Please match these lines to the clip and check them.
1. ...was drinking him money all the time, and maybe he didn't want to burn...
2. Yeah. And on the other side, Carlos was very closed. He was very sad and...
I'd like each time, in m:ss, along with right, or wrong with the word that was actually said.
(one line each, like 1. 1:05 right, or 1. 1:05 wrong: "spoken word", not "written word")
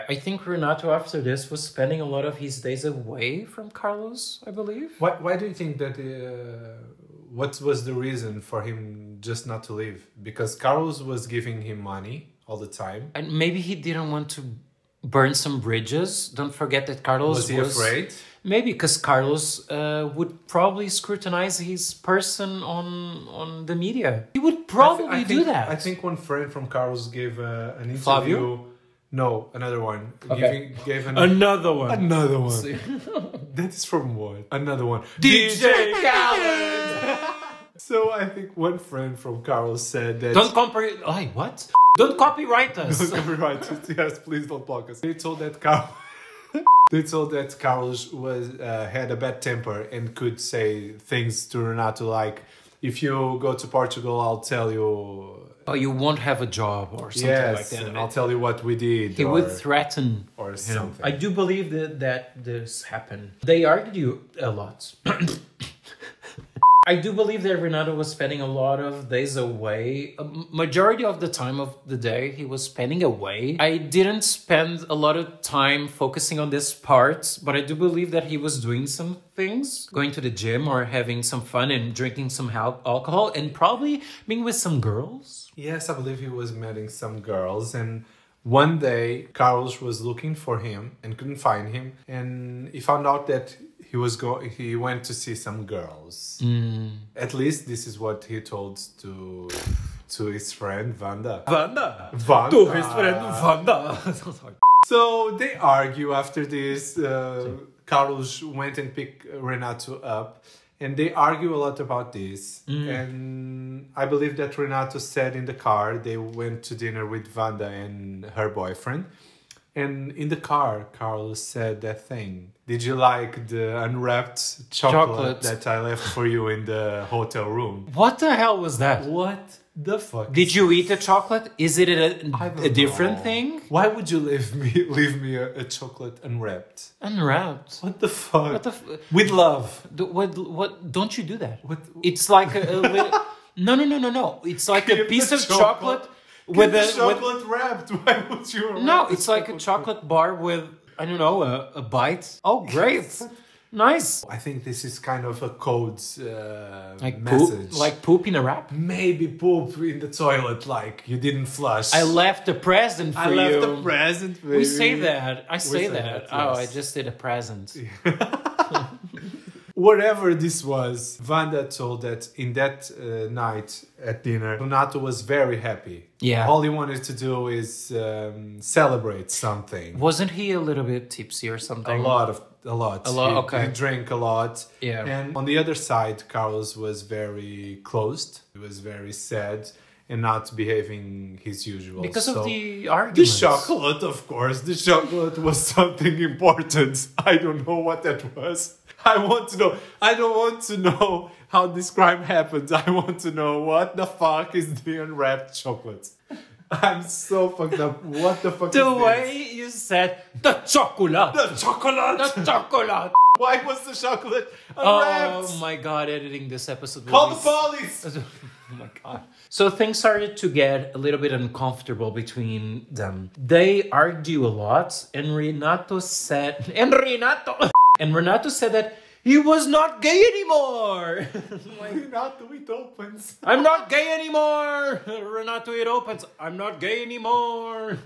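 1. 0:11 wrong: "giving", not "drinking"
2. 3:04 right.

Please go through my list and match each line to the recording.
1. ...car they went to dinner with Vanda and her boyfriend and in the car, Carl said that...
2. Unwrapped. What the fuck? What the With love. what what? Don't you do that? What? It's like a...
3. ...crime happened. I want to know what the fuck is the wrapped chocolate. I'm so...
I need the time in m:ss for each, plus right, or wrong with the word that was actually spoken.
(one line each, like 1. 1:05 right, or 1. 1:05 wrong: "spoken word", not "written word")
1. 1:55 right
2. 2:17 right
3. 3:21 wrong: "unwrapped", not "wrapped".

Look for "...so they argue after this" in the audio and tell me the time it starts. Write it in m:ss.
1:44.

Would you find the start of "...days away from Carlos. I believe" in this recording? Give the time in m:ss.
0:02.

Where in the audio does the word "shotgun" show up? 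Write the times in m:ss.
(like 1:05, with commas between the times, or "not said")
not said.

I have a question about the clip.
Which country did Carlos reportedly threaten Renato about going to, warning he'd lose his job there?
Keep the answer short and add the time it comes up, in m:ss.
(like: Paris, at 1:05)
Portugal, at 0:53.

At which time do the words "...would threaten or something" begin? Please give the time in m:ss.
0:59.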